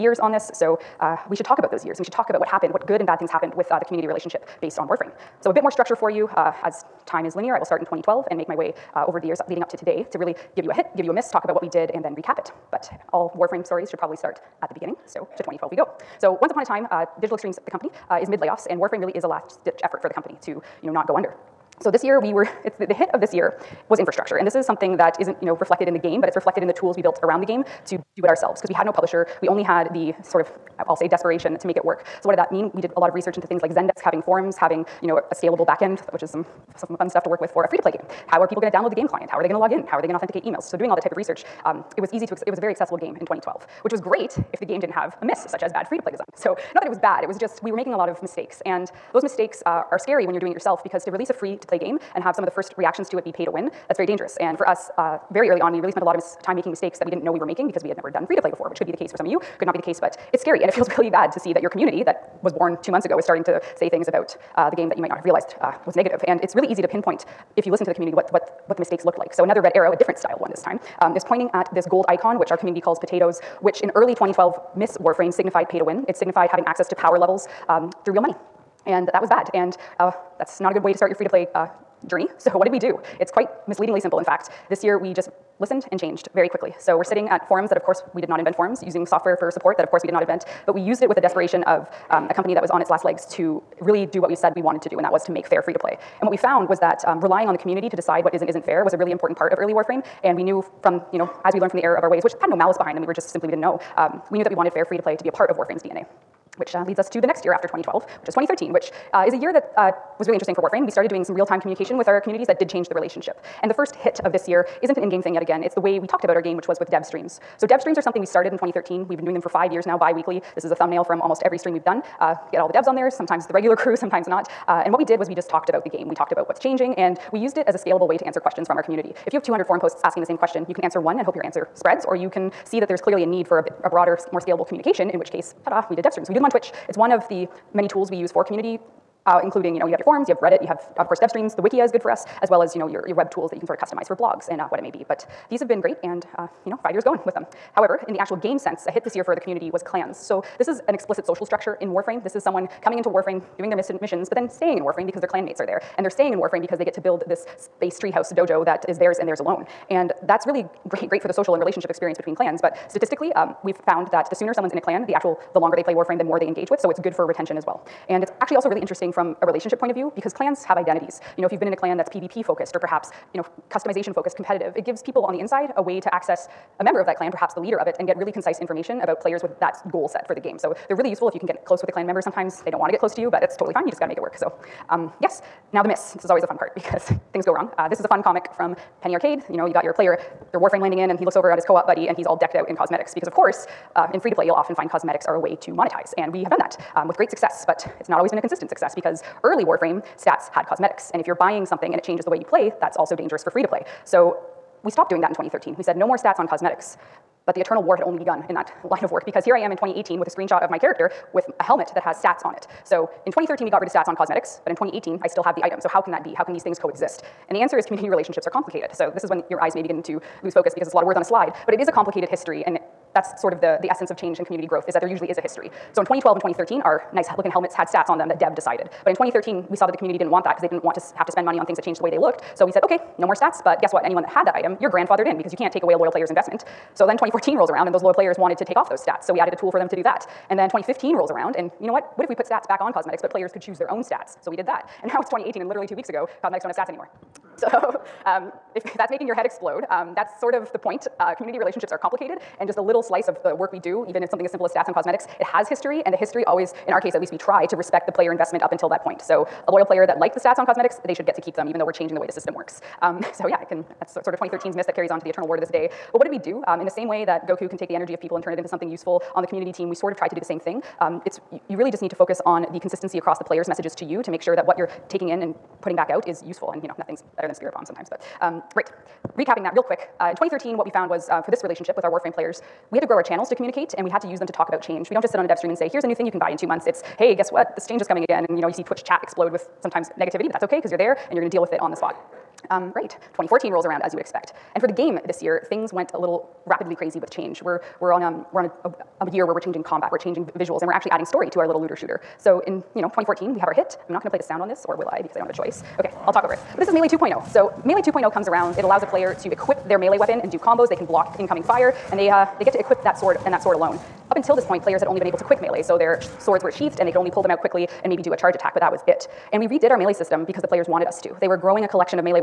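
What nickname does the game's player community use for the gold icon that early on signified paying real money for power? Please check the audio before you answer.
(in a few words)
potatoes.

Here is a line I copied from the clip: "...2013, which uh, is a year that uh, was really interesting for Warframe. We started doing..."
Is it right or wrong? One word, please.
right.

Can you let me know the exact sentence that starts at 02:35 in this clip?
And they're staying in Warframe because they get to build this space treehouse dojo that is theirs and theirs alone.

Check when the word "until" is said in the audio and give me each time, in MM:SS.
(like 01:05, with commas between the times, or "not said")
04:18, 05:14.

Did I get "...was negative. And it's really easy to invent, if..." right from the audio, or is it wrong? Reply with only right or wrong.
wrong.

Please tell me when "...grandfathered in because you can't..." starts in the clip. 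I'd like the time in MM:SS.
03:54.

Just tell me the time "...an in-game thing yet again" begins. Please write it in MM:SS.
01:54.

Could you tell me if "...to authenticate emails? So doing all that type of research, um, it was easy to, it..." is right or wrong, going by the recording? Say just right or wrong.
right.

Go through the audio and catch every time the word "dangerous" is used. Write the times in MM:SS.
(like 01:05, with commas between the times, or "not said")
00:54, 03:23.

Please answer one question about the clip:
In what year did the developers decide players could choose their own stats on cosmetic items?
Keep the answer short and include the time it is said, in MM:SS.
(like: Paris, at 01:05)
2015, at 04:00.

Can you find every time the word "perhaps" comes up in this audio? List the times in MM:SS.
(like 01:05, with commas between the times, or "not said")
02:52, 02:57.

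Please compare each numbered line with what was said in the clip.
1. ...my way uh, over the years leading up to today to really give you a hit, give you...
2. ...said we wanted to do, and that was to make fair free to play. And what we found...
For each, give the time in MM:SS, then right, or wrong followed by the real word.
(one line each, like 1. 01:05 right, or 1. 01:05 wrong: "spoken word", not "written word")
1. 00:08 right
2. 01:34 right.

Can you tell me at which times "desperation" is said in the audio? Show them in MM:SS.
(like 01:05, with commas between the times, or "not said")
00:31, 01:31.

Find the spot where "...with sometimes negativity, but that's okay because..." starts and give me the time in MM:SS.
04:49.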